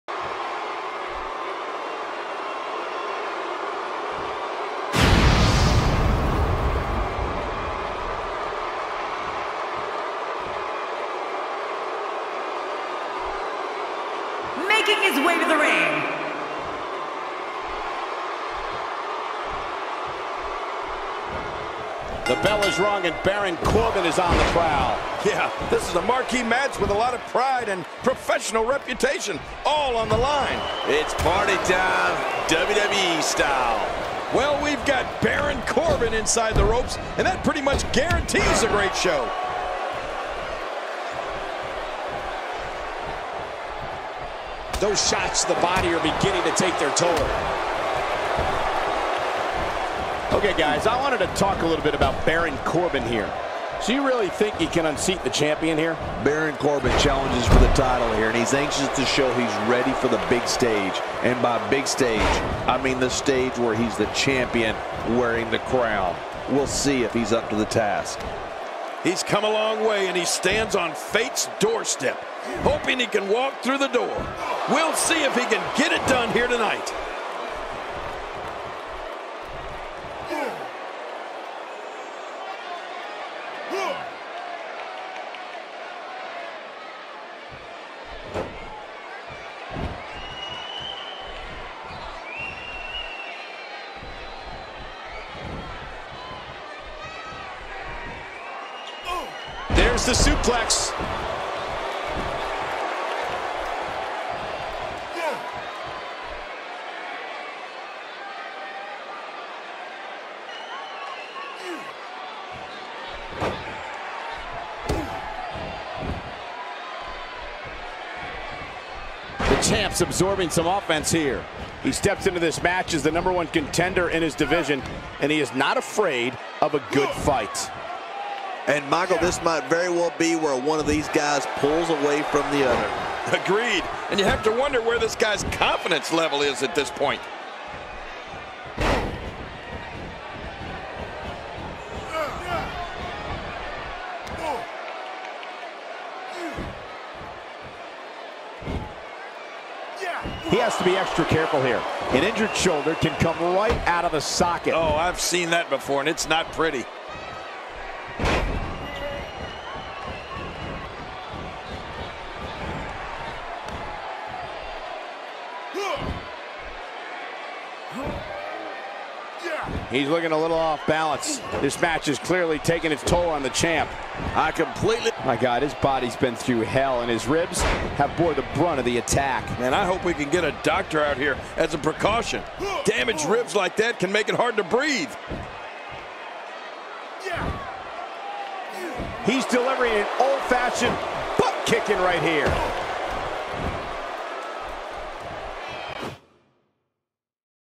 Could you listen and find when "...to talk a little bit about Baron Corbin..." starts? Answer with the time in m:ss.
0:51.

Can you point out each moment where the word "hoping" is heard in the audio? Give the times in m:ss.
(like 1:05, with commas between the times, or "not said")
1:12.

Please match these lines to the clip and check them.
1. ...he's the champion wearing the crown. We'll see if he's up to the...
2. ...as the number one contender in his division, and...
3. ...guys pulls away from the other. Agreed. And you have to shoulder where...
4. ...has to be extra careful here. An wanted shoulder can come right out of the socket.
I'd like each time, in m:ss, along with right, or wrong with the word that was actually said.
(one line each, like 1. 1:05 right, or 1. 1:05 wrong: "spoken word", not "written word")
1. 1:03 right
2. 2:02 right
3. 2:11 wrong: "wonder", not "shoulder"
4. 2:30 wrong: "injured", not "wanted".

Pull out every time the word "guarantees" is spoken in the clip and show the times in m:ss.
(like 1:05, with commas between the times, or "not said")
0:37.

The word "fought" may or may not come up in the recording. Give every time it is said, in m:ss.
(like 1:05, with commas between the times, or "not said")
not said.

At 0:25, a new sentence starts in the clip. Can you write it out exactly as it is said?
Yeah, this is a marquee match with a lot of pride and professional reputation all on the line.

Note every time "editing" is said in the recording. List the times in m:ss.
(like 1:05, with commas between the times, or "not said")
not said.